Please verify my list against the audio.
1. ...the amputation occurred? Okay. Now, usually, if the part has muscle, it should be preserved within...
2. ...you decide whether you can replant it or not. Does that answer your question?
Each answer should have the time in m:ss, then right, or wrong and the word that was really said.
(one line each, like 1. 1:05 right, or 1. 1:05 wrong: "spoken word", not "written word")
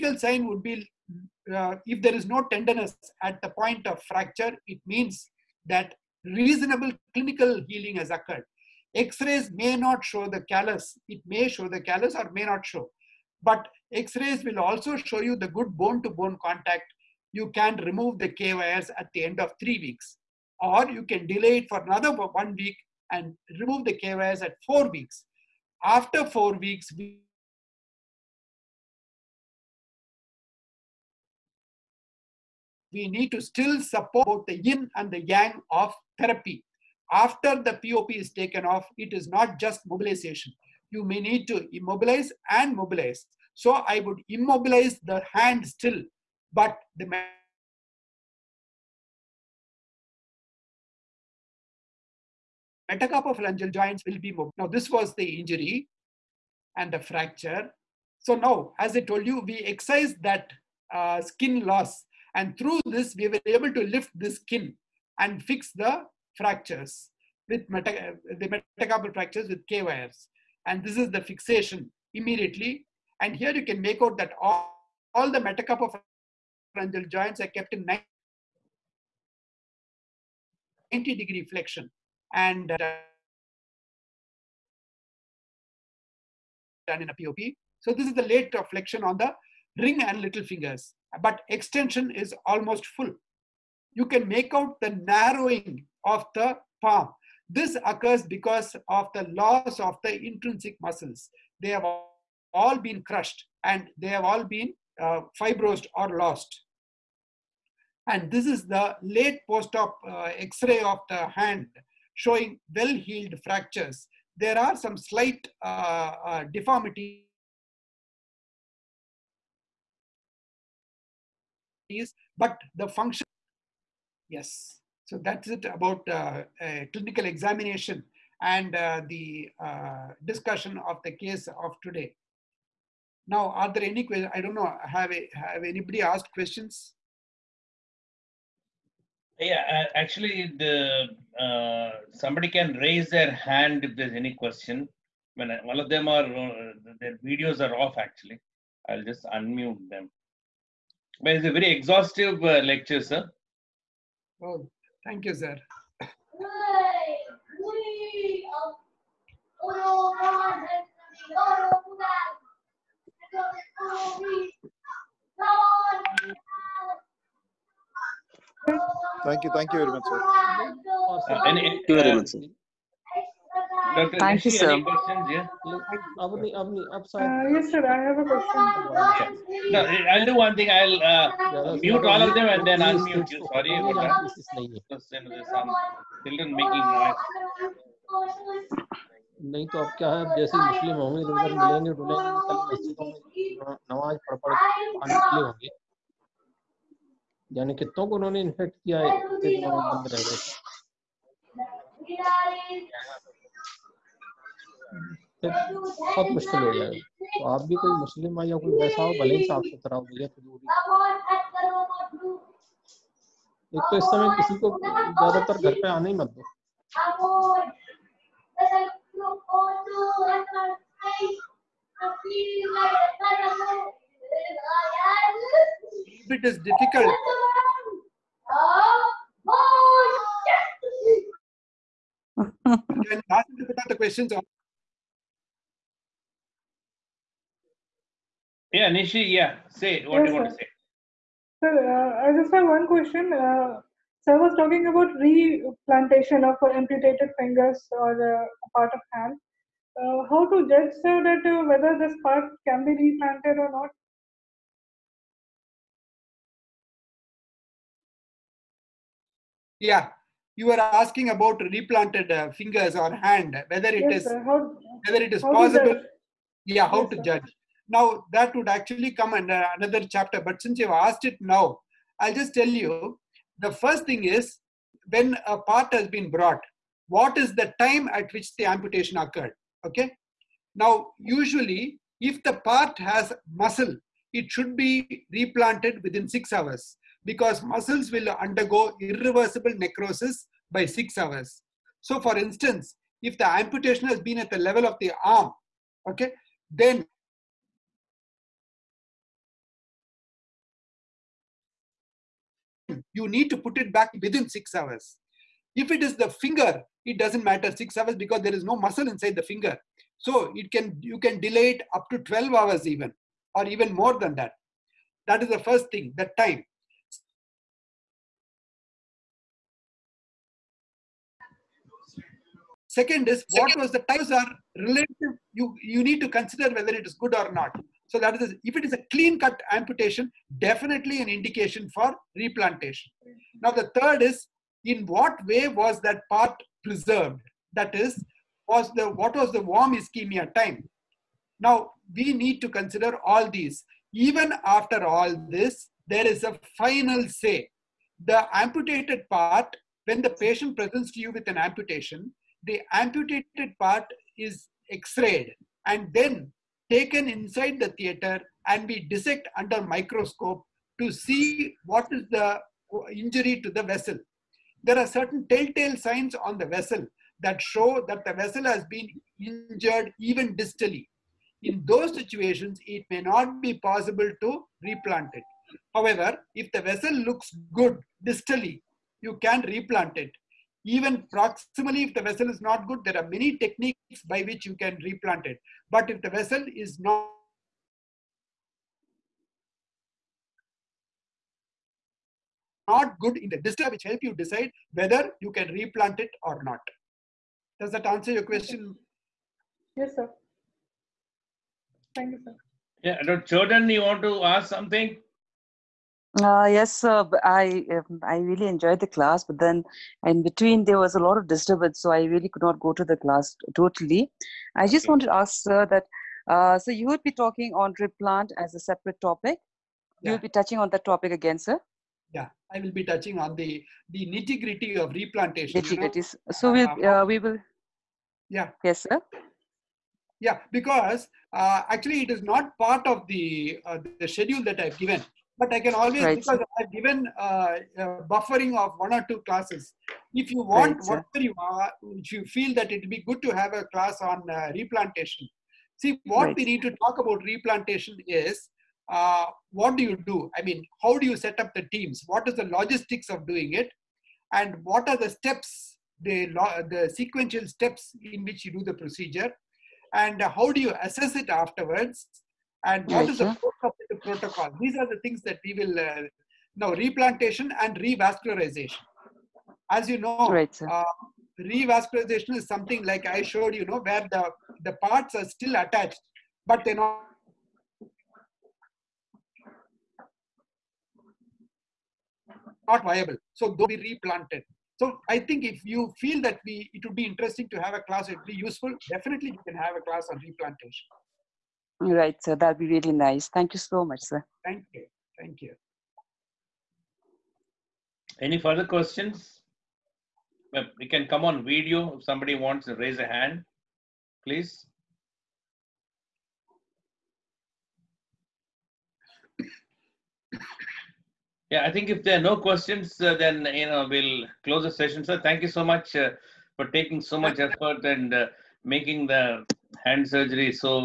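1. 4:38 wrong: "replanted", not "preserved"
2. 6:34 right.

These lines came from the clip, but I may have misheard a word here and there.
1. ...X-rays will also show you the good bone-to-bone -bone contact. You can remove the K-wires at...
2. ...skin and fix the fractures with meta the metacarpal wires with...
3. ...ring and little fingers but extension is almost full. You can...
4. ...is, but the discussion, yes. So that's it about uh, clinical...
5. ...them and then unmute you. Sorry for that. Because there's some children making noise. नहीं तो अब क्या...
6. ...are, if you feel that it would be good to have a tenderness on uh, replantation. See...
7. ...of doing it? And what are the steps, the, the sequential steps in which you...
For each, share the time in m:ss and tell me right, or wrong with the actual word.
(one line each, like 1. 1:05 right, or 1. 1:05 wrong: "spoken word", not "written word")
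1. 0:13 right
2. 1:04 wrong: "fractures", not "wires"
3. 1:29 right
4. 2:01 wrong: "function", not "discussion"
5. 3:02 right
6. 7:21 wrong: "class", not "tenderness"
7. 7:33 right.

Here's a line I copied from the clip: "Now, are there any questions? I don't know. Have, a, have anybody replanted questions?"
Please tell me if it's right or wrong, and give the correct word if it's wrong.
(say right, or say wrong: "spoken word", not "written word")
wrong: "asked", not "replanted".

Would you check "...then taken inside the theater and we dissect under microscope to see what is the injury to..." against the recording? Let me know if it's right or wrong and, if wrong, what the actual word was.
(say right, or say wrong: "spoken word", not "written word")
right.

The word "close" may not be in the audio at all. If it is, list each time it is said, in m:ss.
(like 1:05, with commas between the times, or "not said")
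8:34.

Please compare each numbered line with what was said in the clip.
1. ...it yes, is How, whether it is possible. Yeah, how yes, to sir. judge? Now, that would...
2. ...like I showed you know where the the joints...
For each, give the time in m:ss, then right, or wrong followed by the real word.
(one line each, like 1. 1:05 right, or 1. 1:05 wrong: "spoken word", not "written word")
1. 4:23 right
2. 7:53 wrong: "parts", not "joints".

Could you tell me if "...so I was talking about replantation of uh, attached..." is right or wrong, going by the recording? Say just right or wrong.
wrong.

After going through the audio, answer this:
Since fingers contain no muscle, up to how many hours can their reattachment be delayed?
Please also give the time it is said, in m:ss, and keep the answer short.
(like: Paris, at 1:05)
12 hours, at 5:12.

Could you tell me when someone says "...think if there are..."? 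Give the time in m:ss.
8:31.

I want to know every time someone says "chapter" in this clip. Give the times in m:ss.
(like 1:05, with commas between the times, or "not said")
4:30.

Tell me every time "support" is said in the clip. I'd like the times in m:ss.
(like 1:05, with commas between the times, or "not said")
0:33.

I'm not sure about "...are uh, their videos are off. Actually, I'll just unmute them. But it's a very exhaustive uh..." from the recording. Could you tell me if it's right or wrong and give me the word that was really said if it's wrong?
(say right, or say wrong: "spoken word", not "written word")
right.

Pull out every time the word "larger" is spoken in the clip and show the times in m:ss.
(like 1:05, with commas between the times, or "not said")
not said.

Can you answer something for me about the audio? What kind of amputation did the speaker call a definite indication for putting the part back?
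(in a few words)
clean cut.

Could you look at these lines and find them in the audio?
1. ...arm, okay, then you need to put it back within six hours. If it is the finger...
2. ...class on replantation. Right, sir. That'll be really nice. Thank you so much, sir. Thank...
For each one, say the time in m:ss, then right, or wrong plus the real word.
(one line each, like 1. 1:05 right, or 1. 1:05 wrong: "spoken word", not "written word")
1. 4:55 right
2. 8:10 right.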